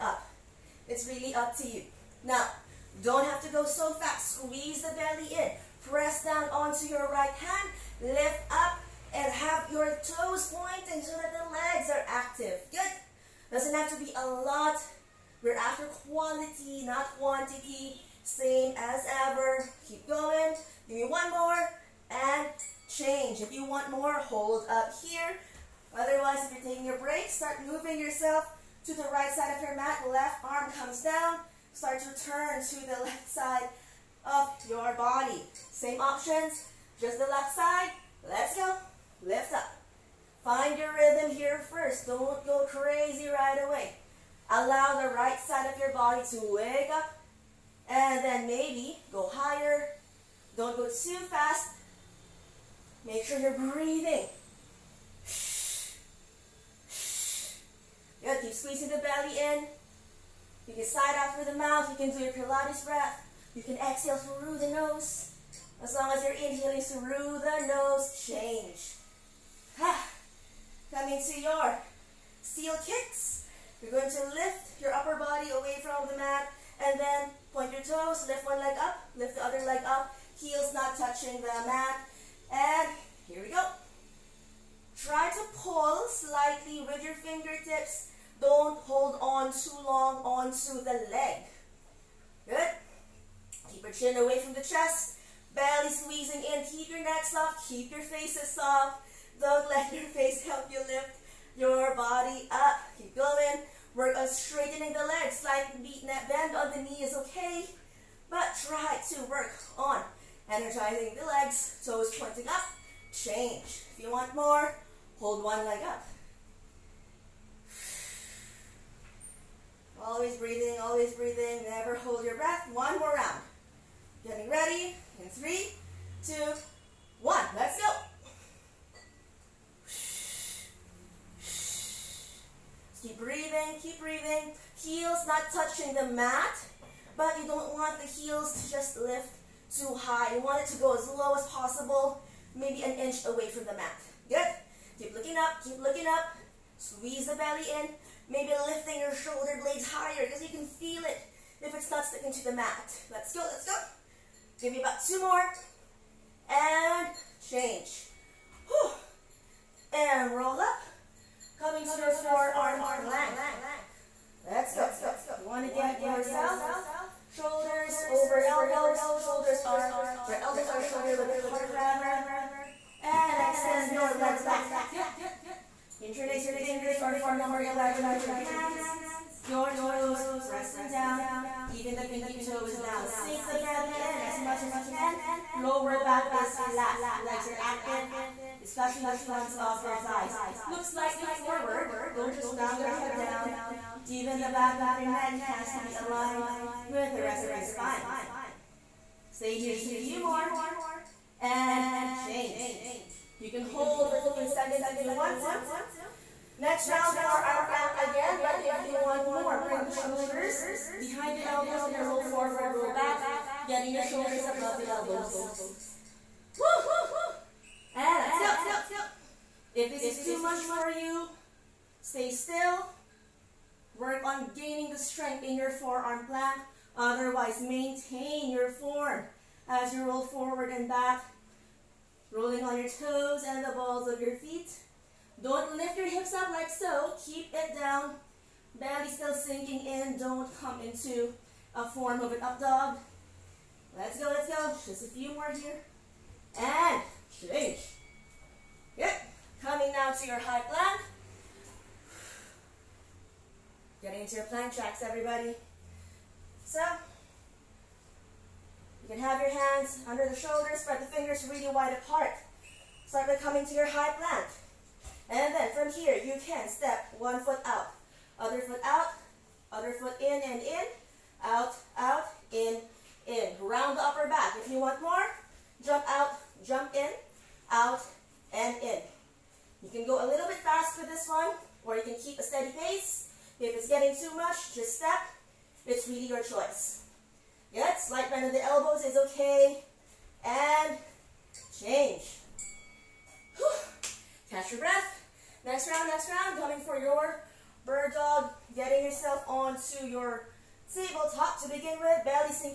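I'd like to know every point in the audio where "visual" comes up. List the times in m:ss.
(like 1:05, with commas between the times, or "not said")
not said.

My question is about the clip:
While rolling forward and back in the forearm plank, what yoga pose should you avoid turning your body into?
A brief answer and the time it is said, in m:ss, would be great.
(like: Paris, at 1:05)
up dog, at 4:02.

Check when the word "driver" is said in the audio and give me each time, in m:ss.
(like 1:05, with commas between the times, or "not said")
not said.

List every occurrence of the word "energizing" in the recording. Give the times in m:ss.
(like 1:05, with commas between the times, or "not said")
1:50.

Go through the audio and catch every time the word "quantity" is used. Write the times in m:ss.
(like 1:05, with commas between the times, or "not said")
0:17.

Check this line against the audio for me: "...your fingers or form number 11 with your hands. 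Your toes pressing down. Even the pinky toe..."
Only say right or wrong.
right.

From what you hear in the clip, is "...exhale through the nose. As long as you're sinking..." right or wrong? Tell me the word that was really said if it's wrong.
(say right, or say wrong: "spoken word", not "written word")
wrong: "inhaling", not "sinking".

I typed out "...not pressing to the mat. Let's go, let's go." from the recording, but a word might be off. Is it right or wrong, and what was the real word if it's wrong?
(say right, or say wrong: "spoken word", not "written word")
wrong: "sticking", not "pressing".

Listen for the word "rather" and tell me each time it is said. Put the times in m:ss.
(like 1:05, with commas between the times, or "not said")
2:51.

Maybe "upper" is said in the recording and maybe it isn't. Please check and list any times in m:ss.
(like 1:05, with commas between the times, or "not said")
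1:14, 4:34.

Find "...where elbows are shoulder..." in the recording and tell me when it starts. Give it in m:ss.
2:50.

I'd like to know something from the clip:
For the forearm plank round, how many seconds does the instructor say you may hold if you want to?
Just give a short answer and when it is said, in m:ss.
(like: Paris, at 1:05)
15, at 3:24.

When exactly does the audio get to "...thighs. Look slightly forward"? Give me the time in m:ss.
3:09.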